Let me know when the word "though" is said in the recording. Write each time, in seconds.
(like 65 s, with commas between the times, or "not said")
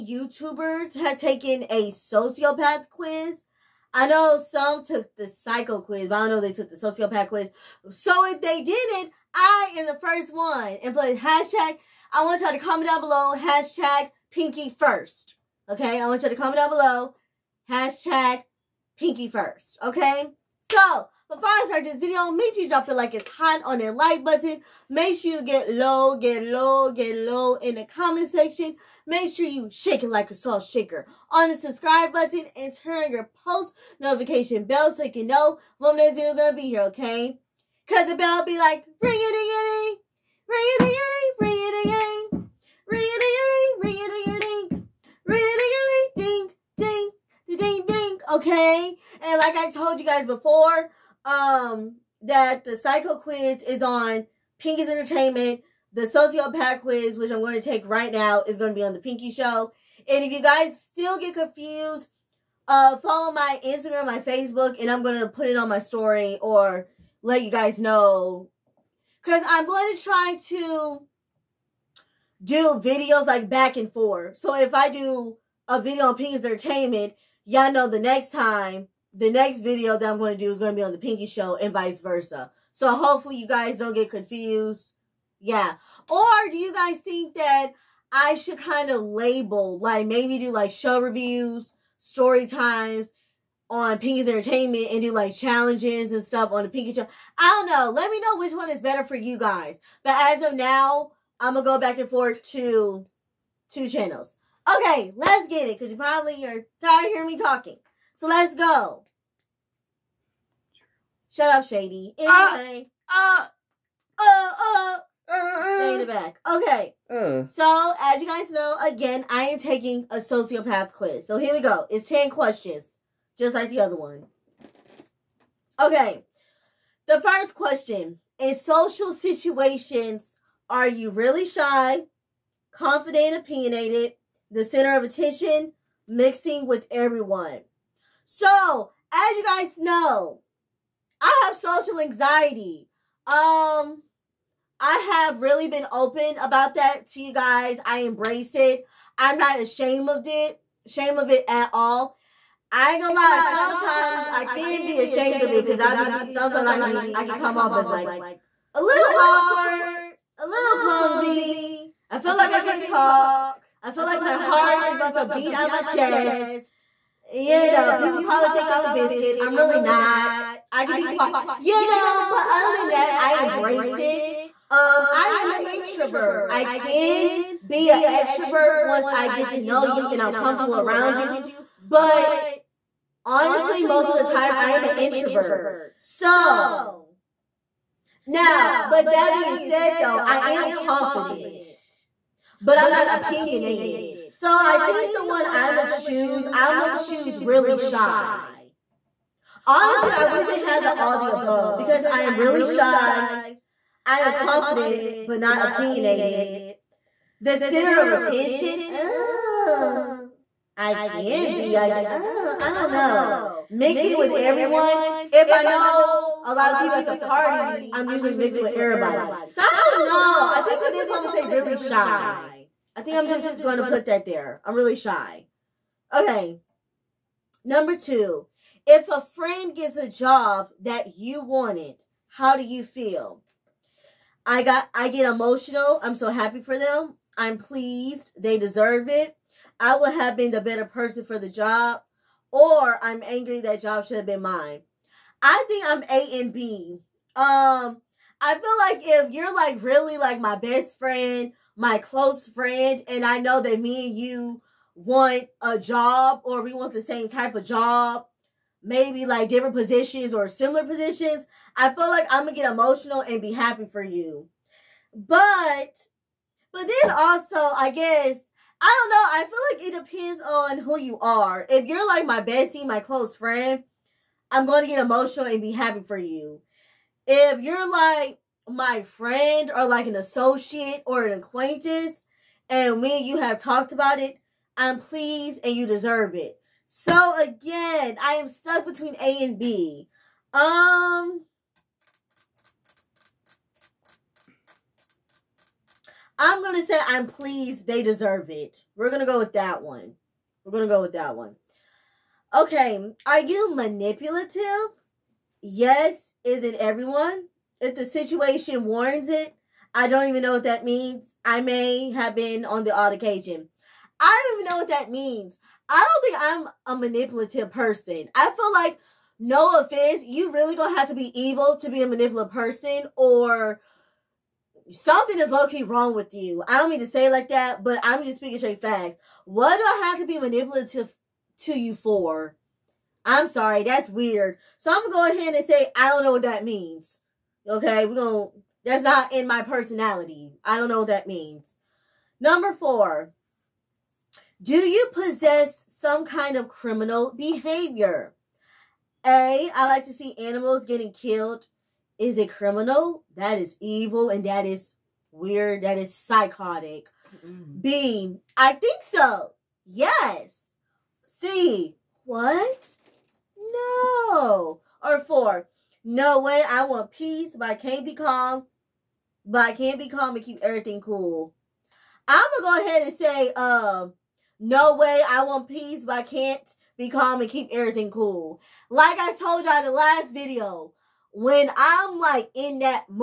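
189 s.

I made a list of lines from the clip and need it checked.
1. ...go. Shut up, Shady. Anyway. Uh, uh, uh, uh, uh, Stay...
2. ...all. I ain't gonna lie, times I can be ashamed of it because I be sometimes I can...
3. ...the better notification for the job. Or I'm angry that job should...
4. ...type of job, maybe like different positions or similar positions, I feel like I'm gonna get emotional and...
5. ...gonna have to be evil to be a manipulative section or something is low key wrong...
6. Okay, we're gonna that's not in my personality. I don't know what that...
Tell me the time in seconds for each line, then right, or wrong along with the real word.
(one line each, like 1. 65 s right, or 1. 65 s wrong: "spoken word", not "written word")
1. 108 s right
2. 151 s wrong: "sometimes", not "times"
3. 240 s wrong: "person", not "notification"
4. 257 s right
5. 320 s wrong: "person", not "section"
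6. 337 s right.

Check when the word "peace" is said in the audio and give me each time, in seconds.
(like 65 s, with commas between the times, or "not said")
367 s, 375 s.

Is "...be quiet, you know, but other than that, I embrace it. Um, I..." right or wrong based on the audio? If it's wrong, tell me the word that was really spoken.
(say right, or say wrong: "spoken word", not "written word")
right.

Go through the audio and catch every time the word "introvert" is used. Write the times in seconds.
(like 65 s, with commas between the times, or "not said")
175 s, 184 s.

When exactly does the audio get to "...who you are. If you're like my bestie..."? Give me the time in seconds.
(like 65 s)
270 s.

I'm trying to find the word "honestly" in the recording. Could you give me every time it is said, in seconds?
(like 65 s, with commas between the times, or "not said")
183 s, 199 s.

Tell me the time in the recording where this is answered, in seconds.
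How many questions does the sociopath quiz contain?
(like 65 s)
122 s.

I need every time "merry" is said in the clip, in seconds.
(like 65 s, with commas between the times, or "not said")
not said.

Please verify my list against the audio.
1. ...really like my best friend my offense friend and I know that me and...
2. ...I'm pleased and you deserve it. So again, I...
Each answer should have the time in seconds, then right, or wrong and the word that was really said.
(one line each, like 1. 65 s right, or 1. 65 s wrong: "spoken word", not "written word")
1. 249 s wrong: "close", not "offense"
2. 284 s right.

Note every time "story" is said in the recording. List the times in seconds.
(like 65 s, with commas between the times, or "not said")
65 s, 91 s.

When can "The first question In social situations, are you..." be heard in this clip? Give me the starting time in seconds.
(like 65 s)
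127 s.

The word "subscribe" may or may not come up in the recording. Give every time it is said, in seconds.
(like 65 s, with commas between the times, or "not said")
31 s.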